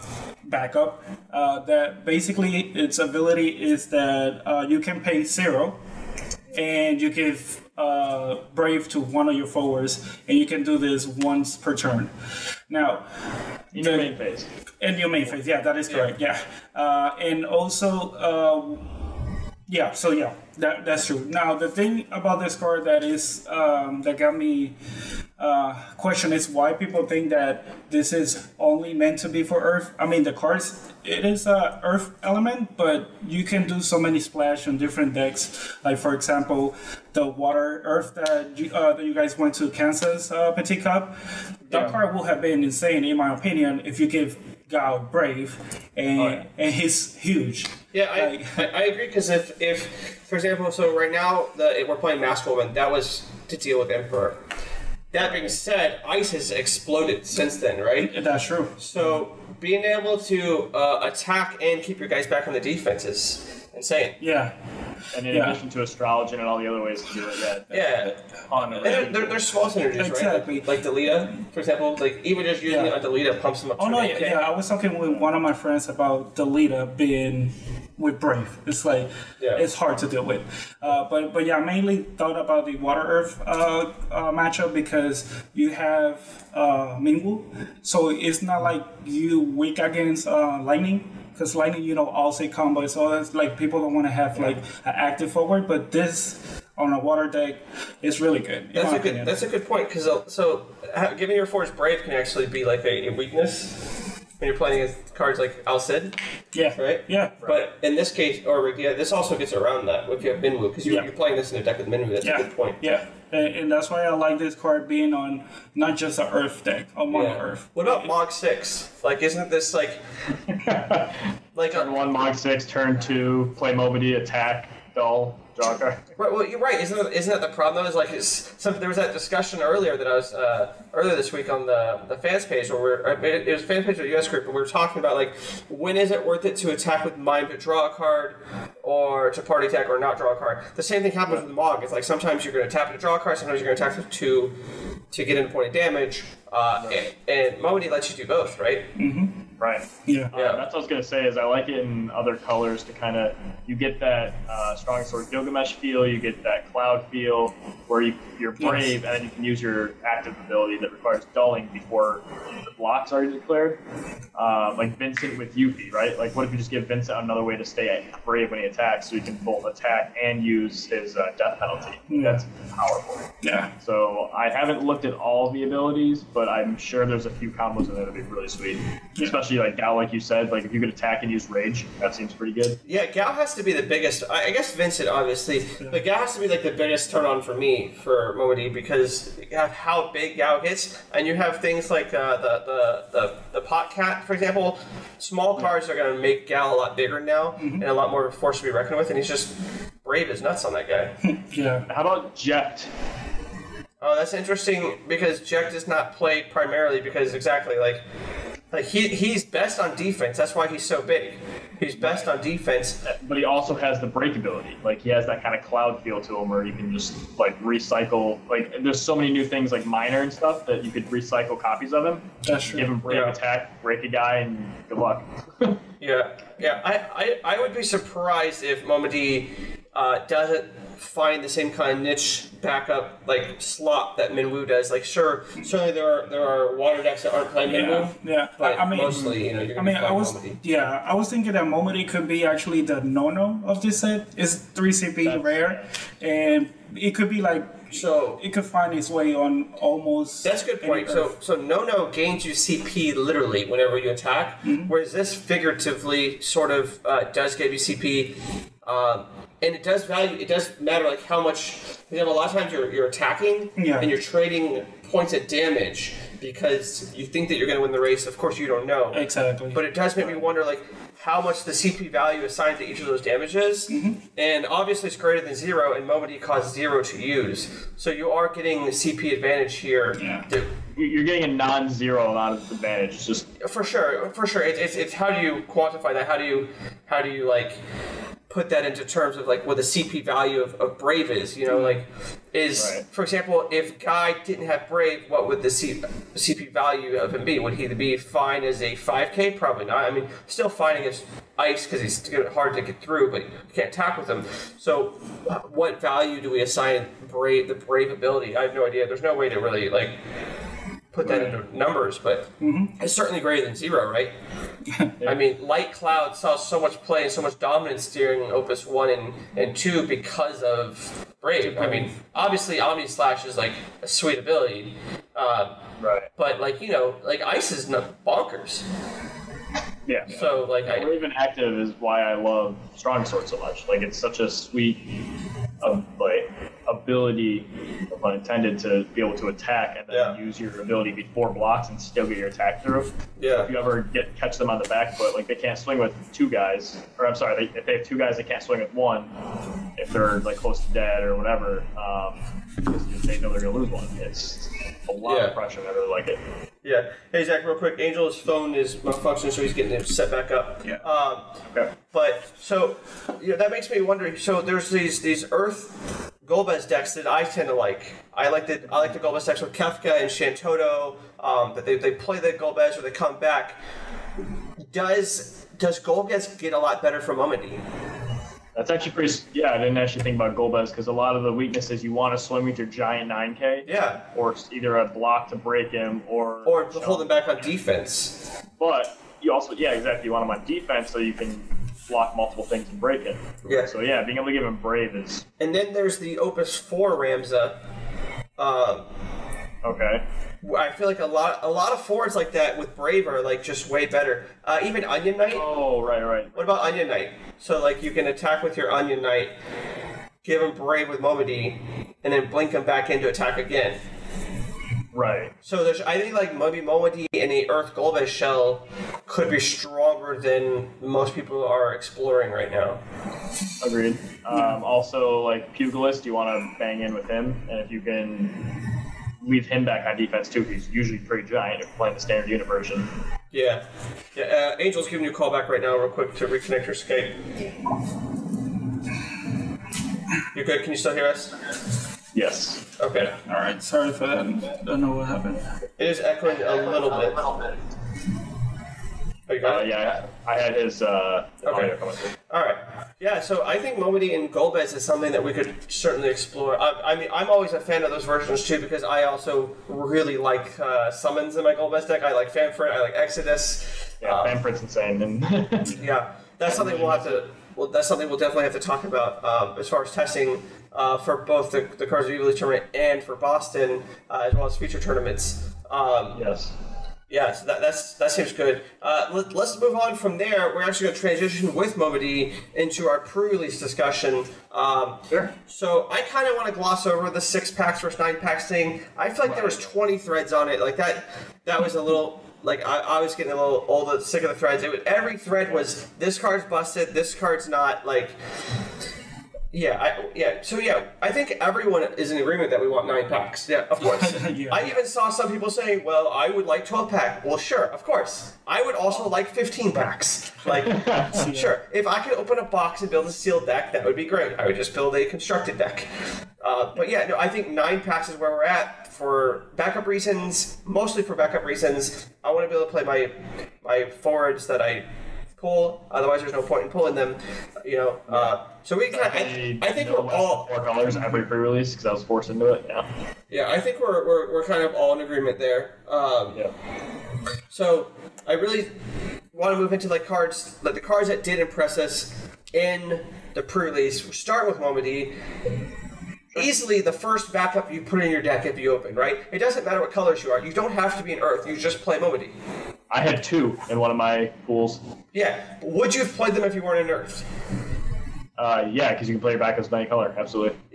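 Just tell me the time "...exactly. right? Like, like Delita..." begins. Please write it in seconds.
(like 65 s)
70 s.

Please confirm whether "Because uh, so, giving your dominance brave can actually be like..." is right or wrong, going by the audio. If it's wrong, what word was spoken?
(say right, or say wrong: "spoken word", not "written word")
wrong: "force", not "dominance".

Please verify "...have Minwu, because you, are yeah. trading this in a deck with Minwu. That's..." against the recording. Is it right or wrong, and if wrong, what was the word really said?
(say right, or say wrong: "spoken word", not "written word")
wrong: "playing", not "trading".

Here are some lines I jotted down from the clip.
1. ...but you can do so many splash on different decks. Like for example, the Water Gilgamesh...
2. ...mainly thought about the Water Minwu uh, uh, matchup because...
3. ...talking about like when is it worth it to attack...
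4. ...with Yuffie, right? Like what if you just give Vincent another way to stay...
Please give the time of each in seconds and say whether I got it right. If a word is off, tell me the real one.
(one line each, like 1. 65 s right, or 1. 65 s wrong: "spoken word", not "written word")
1. 32 s wrong: "Earth", not "Gilgamesh"
2. 81 s wrong: "Earth", not "Minwu"
3. 134 s right
4. 165 s right.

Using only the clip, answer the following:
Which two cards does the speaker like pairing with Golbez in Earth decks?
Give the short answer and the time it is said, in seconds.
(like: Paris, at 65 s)
Kefka and Shantotto, at 369 s.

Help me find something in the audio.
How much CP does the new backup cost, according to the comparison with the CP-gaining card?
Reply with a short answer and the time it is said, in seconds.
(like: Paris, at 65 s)
3, at 244 s.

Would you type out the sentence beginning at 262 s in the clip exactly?
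You know, a lot of times you're, you're attacking yeah.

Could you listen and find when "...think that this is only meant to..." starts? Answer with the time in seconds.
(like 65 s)
27 s.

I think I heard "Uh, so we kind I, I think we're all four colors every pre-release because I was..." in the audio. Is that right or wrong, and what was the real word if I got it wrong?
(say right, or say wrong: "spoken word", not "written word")
right.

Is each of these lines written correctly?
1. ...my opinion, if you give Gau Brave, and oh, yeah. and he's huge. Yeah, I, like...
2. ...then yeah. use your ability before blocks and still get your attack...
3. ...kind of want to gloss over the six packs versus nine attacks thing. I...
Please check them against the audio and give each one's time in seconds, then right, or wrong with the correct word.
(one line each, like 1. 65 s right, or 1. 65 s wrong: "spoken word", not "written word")
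1. 43 s right
2. 340 s right
3. 486 s wrong: "packs", not "attacks".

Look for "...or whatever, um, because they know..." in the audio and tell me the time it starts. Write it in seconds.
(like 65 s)
351 s.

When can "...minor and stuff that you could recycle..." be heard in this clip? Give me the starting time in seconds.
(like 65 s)
219 s.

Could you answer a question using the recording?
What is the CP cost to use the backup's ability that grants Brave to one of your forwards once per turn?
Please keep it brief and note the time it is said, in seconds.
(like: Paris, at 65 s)
0, at 4 s.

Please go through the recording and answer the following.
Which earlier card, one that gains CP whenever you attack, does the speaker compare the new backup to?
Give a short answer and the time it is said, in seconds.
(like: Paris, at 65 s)
Nono, at 243 s.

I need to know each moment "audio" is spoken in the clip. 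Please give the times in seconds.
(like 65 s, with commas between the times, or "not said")
451 s.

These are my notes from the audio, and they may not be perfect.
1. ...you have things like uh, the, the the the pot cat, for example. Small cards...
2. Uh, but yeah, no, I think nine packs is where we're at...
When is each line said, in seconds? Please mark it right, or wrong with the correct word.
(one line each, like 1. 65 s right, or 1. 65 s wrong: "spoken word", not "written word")
1. 191 s right
2. 516 s right.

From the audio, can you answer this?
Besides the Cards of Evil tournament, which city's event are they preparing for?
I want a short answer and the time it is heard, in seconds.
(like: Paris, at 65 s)
Boston, at 473 s.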